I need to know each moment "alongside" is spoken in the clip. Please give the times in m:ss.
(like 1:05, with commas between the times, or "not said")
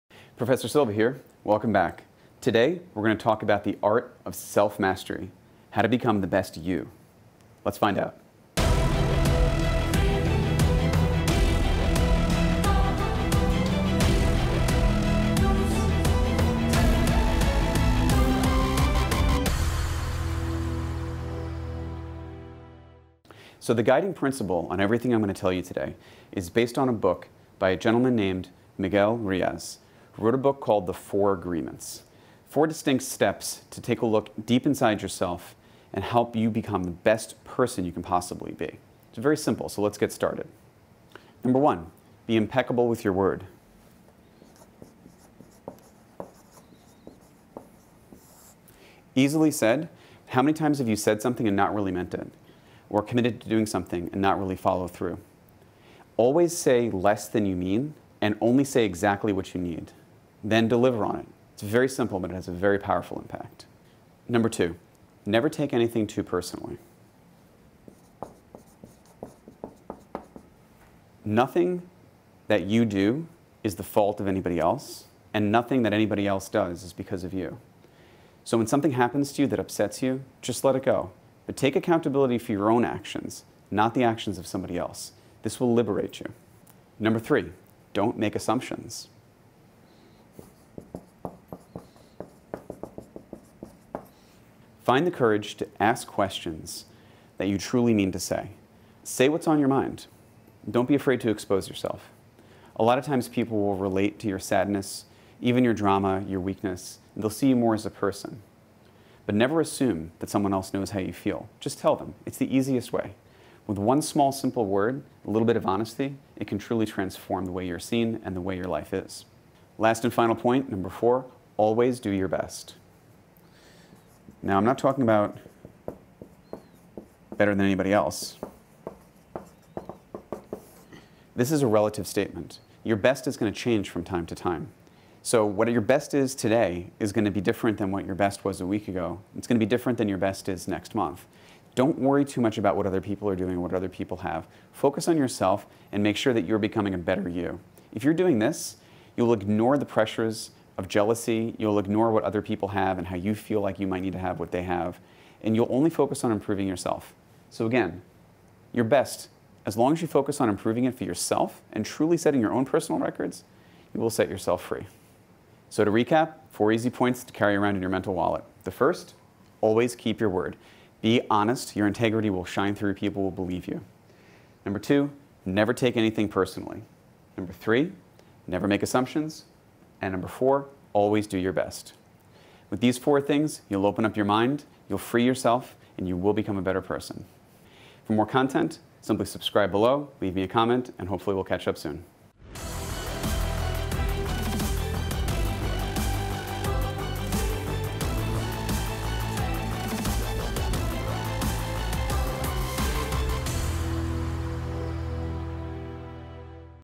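not said.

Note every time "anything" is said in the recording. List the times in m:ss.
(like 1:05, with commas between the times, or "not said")
1:05, 2:55.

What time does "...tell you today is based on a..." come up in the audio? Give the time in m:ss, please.
0:25.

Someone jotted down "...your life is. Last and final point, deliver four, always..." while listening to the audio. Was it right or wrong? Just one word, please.
wrong.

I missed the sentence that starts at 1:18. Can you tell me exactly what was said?
So when something happens to you that upsets you, just let it go.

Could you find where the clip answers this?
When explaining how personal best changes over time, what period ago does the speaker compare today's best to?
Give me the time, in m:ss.
2:18.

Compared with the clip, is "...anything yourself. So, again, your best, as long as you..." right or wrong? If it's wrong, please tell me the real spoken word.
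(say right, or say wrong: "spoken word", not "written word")
wrong: "improving", not "anything".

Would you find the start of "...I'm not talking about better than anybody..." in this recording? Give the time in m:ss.
2:04.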